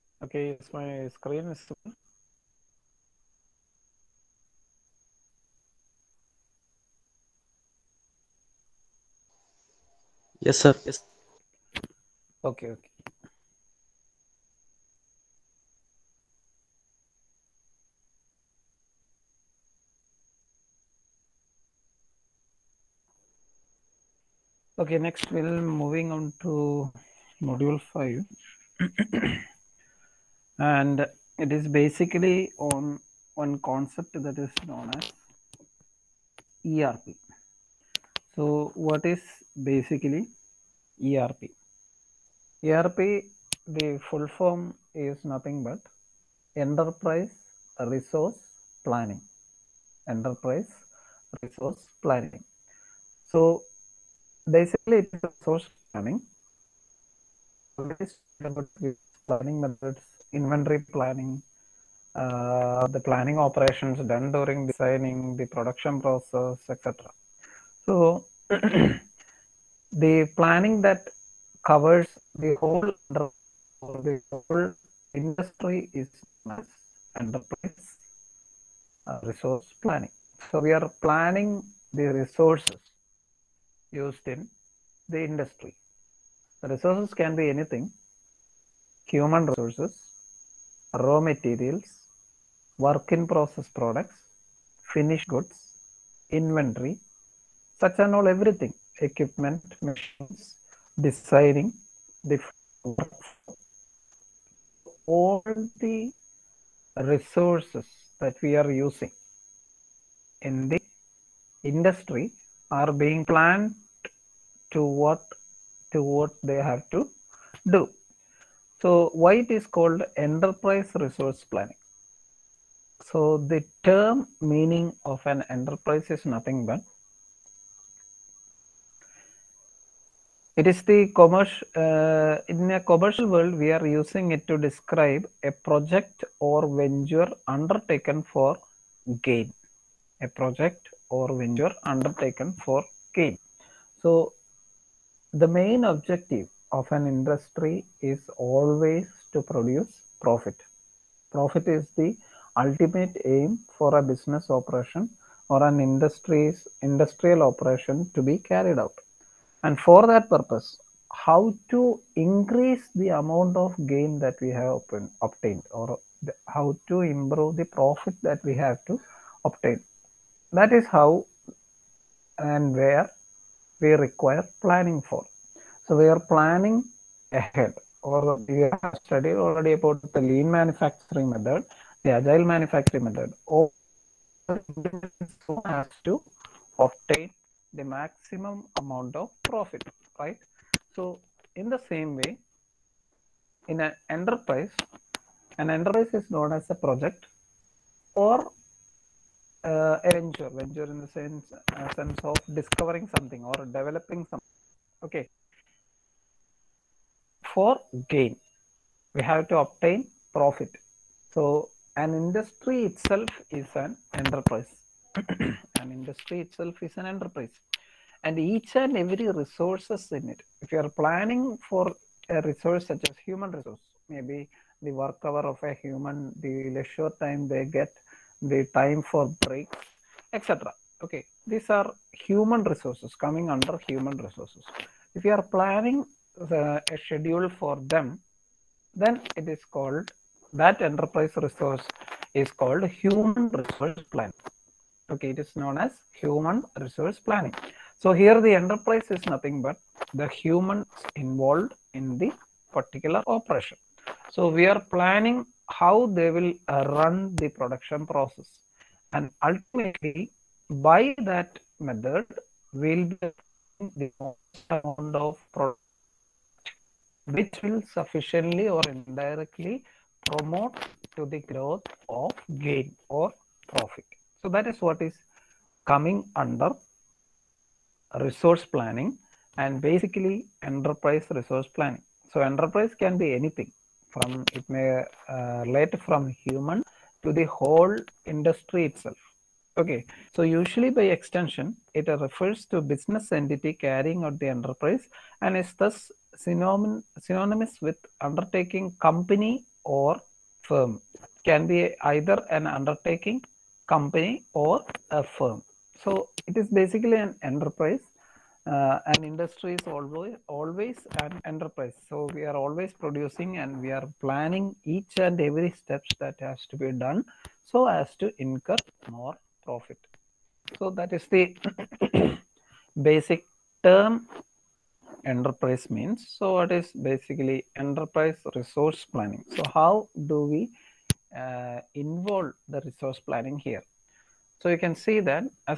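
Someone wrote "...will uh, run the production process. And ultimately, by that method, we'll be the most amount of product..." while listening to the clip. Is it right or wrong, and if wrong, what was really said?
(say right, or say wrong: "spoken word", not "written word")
right.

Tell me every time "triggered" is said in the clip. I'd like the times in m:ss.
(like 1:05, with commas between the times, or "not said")
not said.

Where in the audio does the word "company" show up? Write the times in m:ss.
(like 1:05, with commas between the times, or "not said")
4:59, 5:03.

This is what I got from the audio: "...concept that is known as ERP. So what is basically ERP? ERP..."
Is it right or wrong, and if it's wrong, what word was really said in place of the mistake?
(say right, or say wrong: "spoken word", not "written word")
right.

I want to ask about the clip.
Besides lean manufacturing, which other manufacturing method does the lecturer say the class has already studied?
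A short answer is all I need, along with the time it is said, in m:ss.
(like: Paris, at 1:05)
Agile manufacturing, at 3:02.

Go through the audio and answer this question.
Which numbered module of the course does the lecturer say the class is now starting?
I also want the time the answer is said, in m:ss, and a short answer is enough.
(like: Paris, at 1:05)
5, at 0:27.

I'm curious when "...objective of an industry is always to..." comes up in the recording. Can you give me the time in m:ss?
2:25.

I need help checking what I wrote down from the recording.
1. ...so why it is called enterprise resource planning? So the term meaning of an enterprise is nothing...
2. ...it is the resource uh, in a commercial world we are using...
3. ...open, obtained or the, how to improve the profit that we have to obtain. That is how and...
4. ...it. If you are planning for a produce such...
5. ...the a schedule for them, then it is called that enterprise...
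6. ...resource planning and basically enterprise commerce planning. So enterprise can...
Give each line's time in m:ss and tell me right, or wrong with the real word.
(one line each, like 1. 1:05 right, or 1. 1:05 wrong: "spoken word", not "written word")
1. 1:58 right
2. 2:10 wrong: "commerce", not "resource"
3. 2:44 right
4. 3:40 wrong: "resource", not "produce"
5. 3:56 right
6. 4:38 wrong: "resource", not "commerce".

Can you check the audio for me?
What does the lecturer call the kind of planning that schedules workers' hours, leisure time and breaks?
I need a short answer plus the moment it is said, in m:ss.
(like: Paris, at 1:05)
Human resource planning, at 4:06.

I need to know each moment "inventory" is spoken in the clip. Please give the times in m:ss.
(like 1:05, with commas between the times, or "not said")
1:00, 1:36.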